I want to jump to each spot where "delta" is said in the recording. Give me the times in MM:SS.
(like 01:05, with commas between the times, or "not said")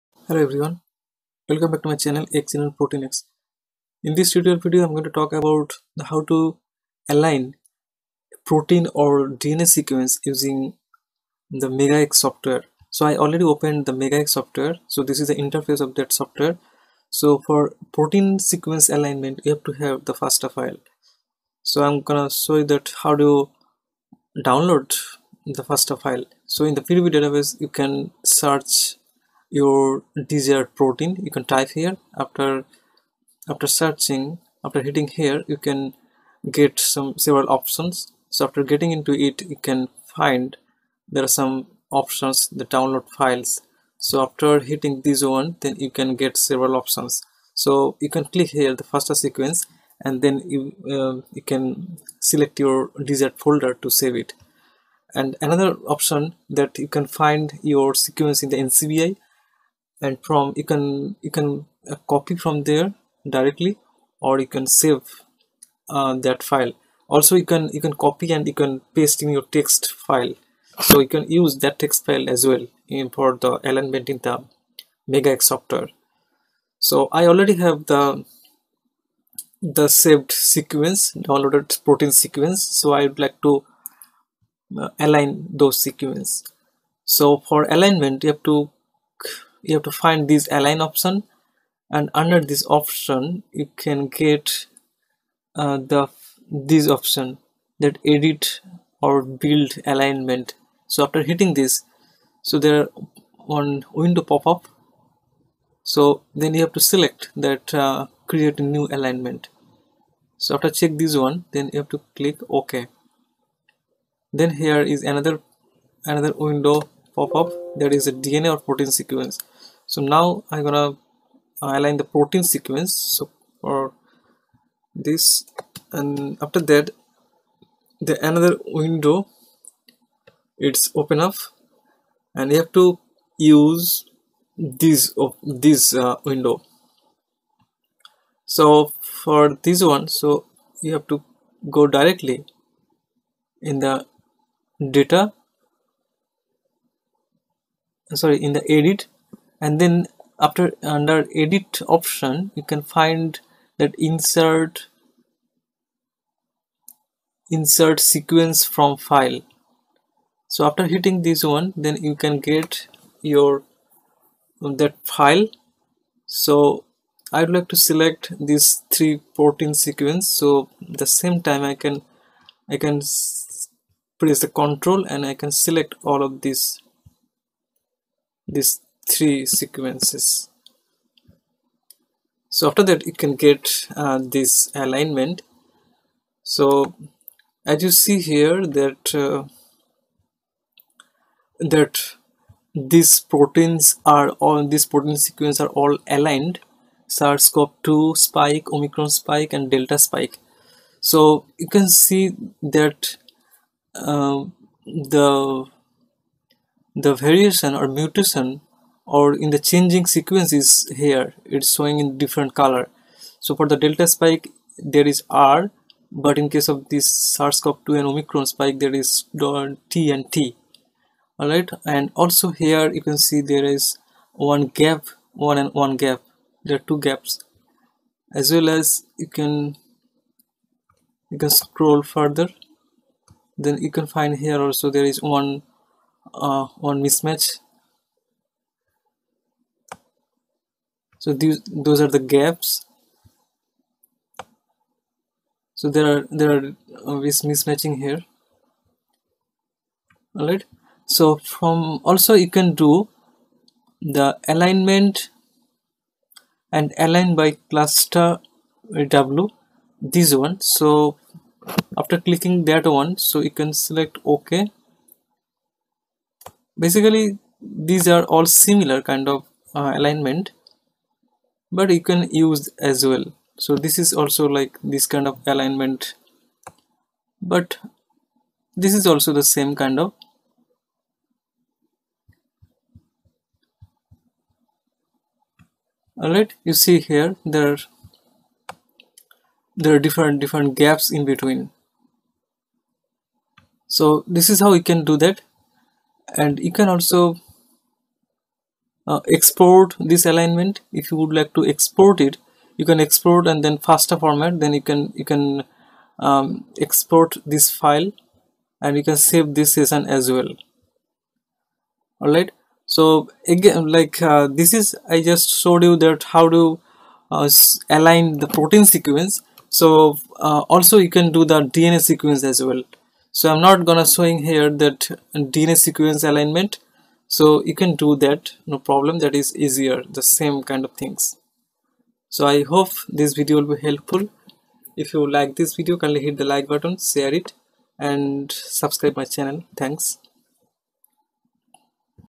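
03:19, 03:33.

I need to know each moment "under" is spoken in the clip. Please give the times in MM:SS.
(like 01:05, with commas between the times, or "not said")
01:32, 02:30.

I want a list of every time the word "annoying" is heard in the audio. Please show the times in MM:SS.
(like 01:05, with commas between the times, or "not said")
not said.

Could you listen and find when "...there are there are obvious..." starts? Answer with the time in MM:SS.
04:05.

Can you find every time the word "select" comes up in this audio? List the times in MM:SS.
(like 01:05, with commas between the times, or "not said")
00:52, 01:46, 02:47, 02:55, 04:23.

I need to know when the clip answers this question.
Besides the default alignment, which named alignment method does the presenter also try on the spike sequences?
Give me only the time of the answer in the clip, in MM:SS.
04:17.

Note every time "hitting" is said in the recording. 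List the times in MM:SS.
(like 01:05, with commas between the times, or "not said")
00:34, 00:44, 01:41, 02:40.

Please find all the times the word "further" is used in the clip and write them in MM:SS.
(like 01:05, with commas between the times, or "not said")
03:52.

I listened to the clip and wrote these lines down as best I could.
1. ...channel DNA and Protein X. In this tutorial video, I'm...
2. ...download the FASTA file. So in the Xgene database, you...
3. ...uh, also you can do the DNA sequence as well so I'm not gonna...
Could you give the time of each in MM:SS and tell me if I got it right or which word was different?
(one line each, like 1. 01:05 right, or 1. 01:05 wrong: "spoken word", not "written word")
1. 00:01 wrong: "Xgene", not "DNA"
2. 00:24 wrong: "PDB", not "Xgene"
3. 05:20 right.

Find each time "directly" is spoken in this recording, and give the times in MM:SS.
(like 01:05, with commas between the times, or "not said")
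01:03, 02:21.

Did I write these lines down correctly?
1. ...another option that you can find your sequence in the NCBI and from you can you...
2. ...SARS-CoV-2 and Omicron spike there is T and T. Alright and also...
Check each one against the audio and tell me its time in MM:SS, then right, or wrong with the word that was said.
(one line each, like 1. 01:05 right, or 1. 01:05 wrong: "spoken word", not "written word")
1. 00:55 right
2. 03:37 right.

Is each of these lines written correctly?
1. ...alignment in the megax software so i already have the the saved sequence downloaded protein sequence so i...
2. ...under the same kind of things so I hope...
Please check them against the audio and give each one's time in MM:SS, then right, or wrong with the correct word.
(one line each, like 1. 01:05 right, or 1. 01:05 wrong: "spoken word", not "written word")
1. 01:13 right
2. 05:29 wrong: "easier", not "under".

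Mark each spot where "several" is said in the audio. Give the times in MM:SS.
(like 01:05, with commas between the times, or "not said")
00:37, 00:46.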